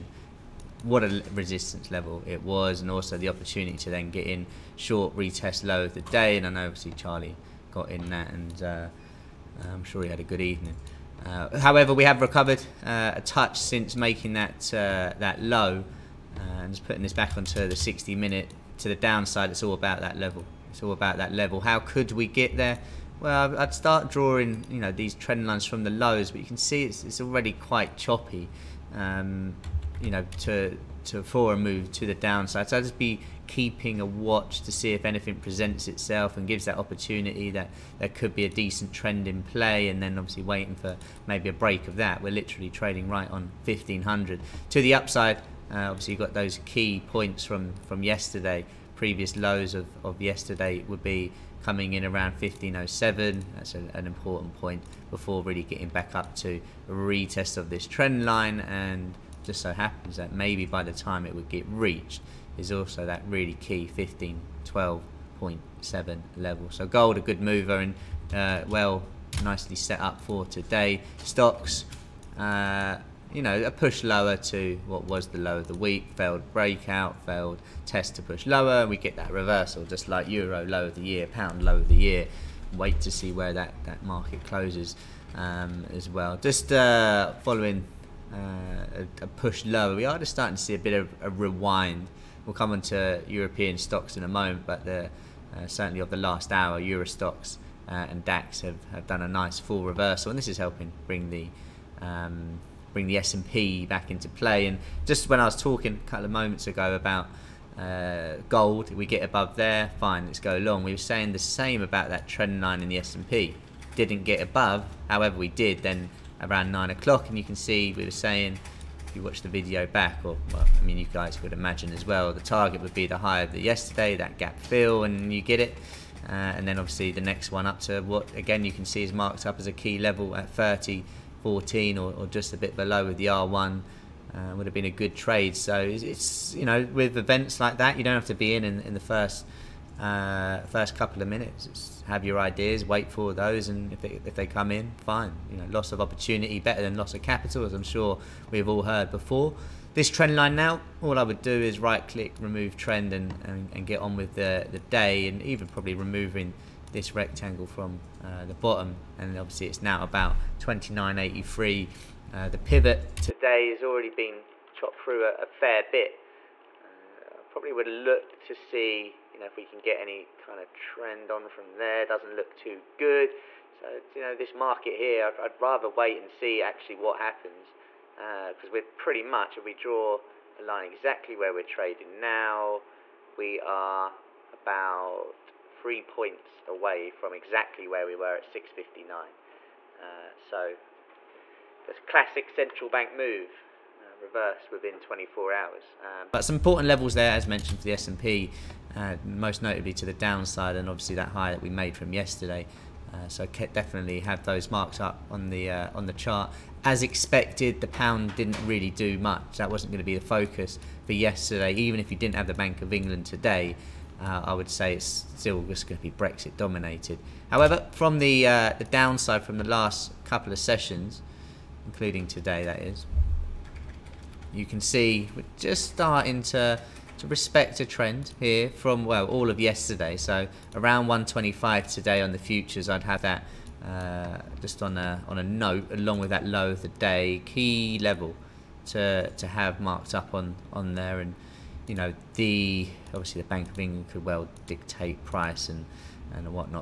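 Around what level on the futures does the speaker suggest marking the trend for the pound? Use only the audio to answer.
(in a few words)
125.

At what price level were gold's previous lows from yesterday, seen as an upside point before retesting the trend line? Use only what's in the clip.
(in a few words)
1507.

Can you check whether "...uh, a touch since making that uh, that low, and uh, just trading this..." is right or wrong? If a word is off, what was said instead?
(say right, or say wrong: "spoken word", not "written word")
wrong: "putting", not "trading".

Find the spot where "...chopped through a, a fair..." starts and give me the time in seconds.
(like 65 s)
164 s.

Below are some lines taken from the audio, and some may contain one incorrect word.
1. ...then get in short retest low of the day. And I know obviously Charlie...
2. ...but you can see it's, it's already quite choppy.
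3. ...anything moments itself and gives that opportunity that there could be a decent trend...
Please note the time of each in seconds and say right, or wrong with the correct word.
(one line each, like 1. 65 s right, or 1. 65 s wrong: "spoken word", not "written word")
1. 3 s right
2. 26 s right
3. 35 s wrong: "presents", not "moments".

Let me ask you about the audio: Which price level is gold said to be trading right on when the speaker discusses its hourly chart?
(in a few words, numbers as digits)
1500.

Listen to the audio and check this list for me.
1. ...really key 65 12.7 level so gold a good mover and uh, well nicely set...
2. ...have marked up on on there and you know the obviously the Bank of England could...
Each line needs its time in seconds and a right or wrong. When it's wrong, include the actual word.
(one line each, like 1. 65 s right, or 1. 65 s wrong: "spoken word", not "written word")
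1. 63 s wrong: "15", not "65"
2. 239 s right.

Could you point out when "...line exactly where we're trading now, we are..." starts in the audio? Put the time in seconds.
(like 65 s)
180 s.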